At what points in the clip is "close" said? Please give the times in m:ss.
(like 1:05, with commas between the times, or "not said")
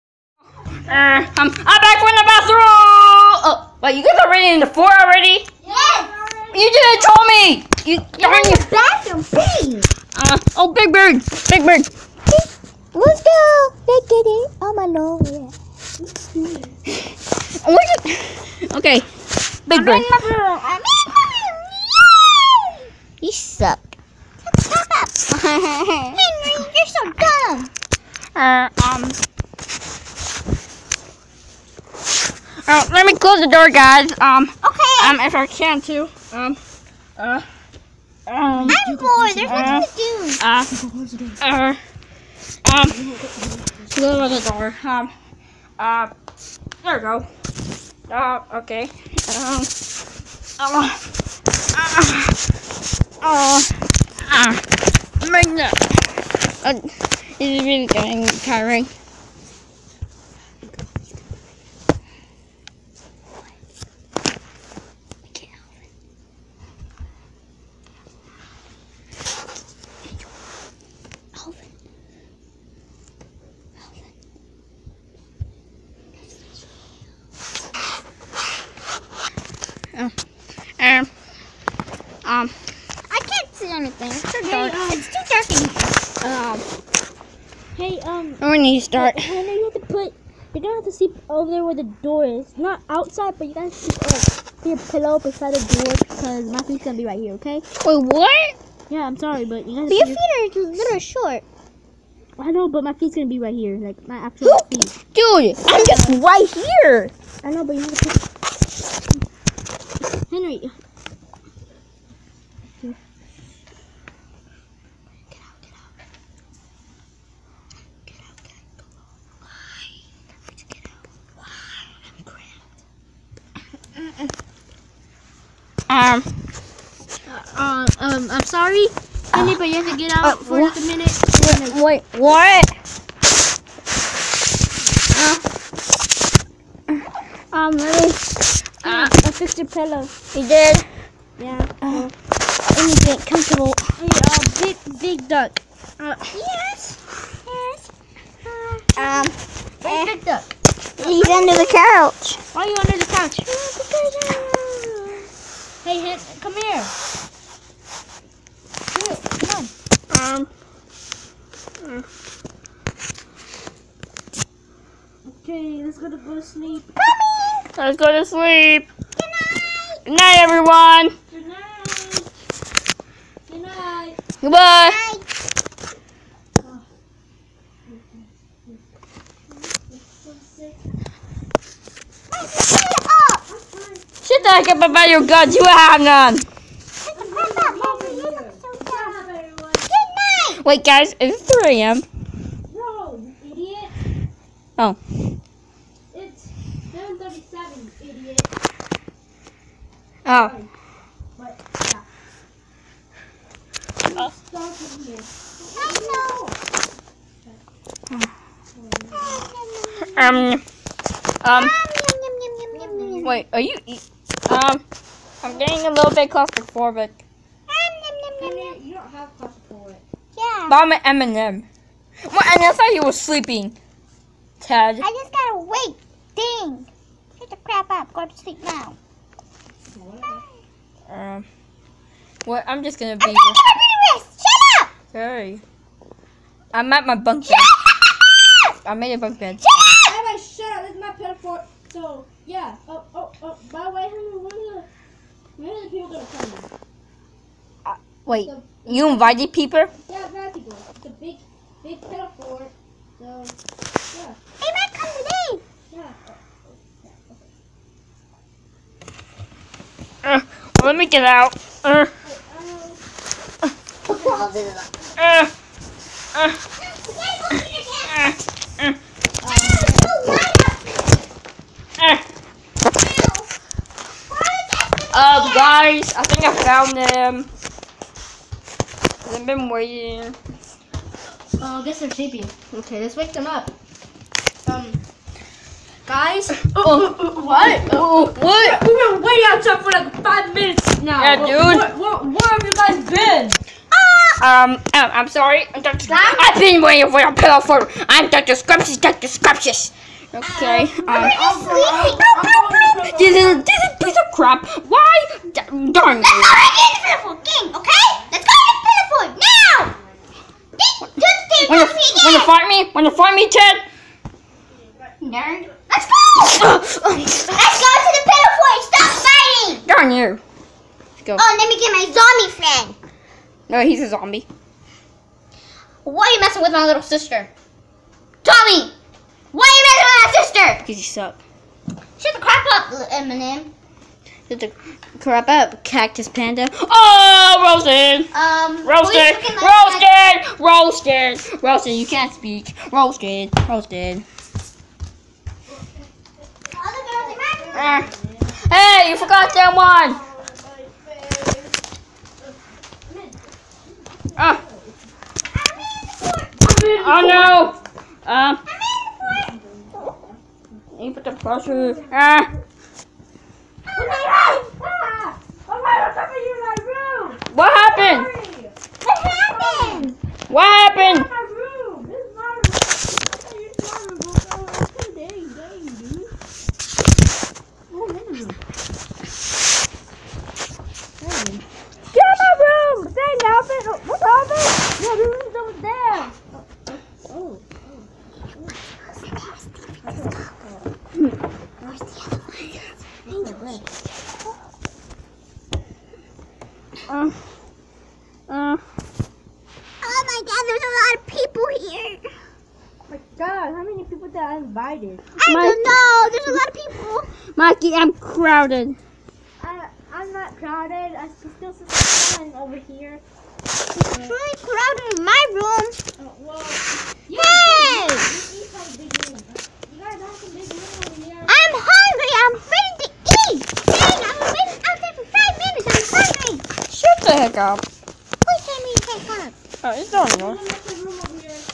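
0:33, 0:43.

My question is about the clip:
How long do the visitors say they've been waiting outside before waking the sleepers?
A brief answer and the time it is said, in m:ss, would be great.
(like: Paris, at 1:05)
5 minutes, at 4:50.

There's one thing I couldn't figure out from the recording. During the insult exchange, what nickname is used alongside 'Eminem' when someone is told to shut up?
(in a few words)
Cactus Panda.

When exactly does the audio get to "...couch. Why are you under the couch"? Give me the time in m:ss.
2:31.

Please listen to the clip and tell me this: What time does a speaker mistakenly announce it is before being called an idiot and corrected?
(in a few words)
3 a.m.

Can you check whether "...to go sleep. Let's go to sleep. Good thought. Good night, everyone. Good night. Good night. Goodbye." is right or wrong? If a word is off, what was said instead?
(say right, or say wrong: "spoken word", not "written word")
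wrong: "night", not "thought".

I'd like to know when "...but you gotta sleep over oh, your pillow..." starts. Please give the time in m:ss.
1:33.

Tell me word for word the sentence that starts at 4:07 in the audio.
Uh, wait, the, you invited people?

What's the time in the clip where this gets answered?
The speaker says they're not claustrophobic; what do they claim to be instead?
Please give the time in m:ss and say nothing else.
3:40.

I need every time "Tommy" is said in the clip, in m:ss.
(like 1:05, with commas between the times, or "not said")
5:28.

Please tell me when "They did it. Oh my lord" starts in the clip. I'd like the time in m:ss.
0:13.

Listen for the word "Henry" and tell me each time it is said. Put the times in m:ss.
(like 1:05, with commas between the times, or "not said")
0:25, 1:50, 4:04.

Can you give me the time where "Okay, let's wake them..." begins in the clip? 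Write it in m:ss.
4:42.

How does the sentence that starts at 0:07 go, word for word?
You You're in the bathroom, please.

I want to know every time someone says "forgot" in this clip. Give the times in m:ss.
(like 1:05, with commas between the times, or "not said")
5:49.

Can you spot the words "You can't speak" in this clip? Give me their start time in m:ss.
5:41.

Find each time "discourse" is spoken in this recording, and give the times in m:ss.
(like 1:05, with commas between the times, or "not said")
not said.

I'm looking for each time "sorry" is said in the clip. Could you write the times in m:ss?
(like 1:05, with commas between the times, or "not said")
1:39, 2:08, 3:55, 4:55.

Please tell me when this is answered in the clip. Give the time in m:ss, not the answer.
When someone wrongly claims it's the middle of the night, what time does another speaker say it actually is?
3:16.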